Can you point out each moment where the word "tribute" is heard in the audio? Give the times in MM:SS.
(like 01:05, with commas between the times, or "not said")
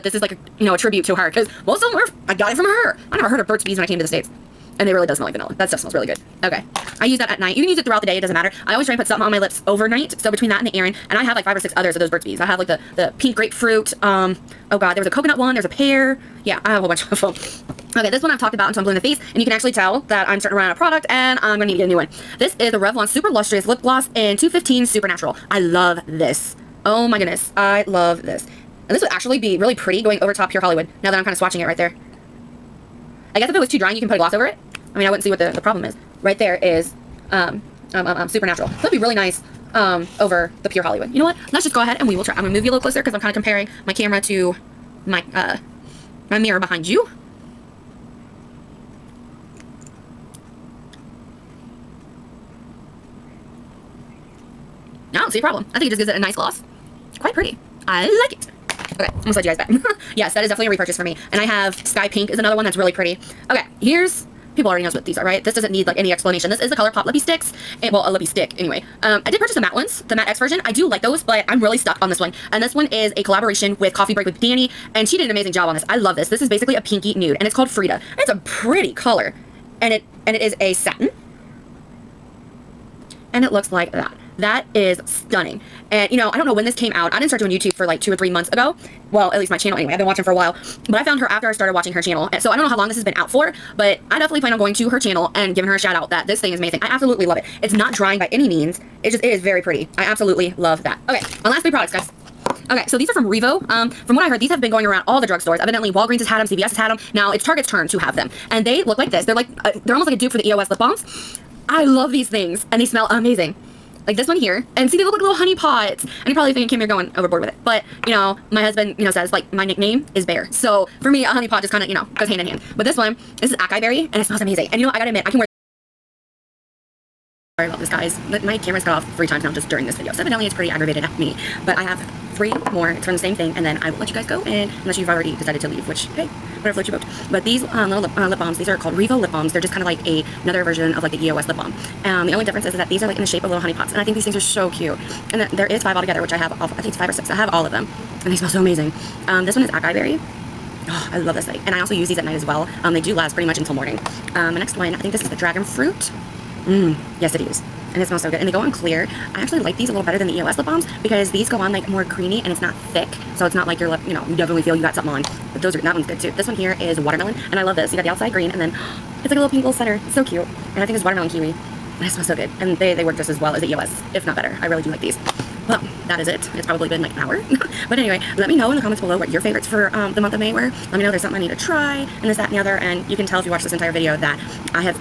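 00:00.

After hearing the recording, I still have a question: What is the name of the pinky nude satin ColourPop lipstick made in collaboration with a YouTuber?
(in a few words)
Frida.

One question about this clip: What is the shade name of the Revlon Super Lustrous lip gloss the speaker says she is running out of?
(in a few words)
215 Supernatural.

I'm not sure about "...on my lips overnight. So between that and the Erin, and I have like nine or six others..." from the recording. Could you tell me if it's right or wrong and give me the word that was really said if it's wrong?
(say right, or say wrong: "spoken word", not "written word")
wrong: "five", not "nine".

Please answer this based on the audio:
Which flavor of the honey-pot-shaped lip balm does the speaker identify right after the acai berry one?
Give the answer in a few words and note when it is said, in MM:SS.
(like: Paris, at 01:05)
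dragon fruit, at 02:35.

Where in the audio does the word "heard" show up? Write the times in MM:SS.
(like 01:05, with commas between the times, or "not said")
00:03, 01:44.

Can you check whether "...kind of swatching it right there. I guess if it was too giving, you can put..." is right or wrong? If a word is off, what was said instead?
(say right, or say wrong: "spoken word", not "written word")
wrong: "drying", not "giving".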